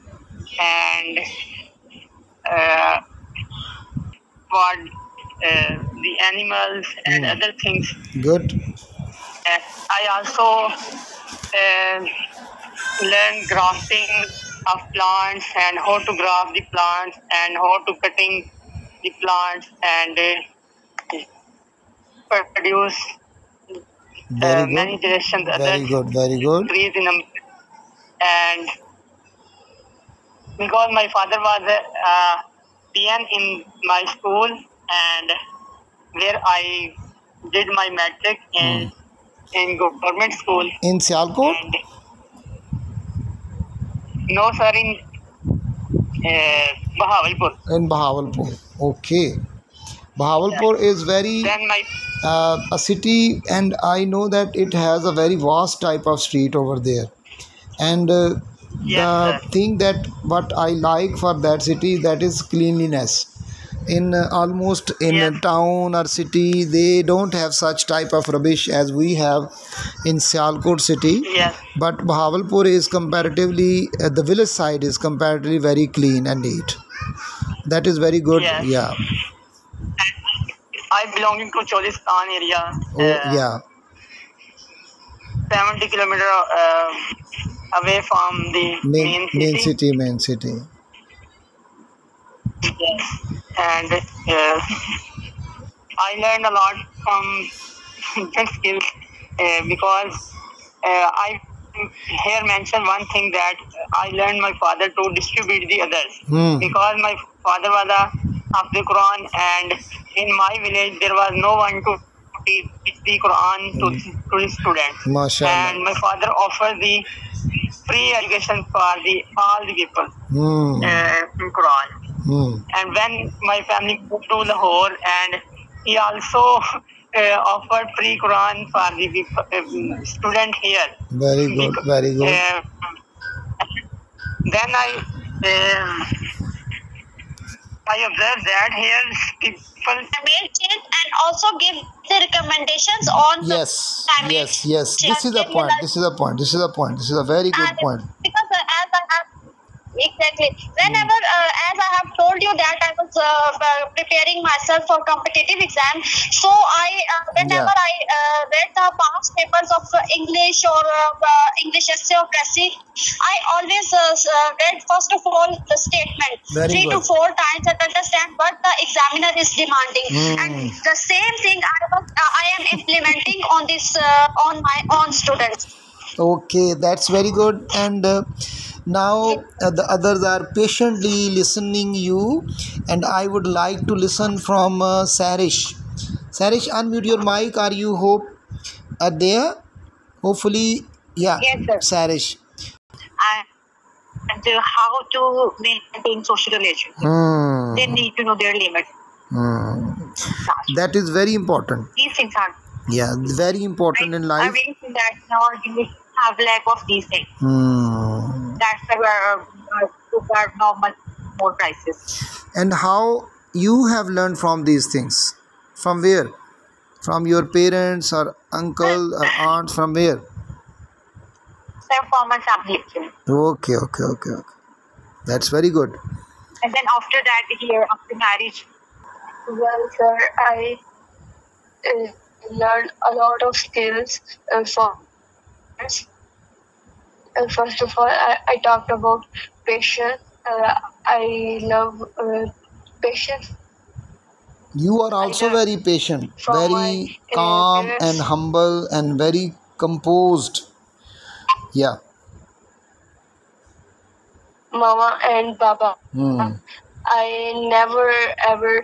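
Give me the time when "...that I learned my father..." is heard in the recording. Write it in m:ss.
1:43.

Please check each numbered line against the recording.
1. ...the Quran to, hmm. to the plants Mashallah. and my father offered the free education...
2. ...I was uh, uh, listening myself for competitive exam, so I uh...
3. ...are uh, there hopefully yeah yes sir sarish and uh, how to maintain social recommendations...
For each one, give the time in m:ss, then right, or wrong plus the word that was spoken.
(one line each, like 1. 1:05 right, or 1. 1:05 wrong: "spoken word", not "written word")
1. 1:53 wrong: "students", not "plants"
2. 2:32 wrong: "preparing", not "listening"
3. 3:09 wrong: "relations", not "recommendations".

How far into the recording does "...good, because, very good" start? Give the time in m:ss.
2:11.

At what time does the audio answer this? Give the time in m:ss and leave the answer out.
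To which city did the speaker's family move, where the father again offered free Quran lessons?
2:04.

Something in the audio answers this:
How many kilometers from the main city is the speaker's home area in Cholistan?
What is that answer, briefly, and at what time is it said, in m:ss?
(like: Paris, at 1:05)
70, at 1:25.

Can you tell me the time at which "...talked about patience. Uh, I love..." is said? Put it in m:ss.
3:58.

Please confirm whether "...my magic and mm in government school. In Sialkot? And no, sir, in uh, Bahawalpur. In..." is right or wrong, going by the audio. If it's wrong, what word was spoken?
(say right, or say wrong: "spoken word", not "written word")
right.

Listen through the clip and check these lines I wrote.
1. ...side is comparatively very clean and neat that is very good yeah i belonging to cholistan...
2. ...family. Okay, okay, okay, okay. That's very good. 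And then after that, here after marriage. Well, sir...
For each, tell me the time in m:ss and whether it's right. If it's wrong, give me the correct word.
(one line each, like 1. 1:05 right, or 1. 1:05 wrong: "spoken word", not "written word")
1. 1:14 right
2. 3:42 right.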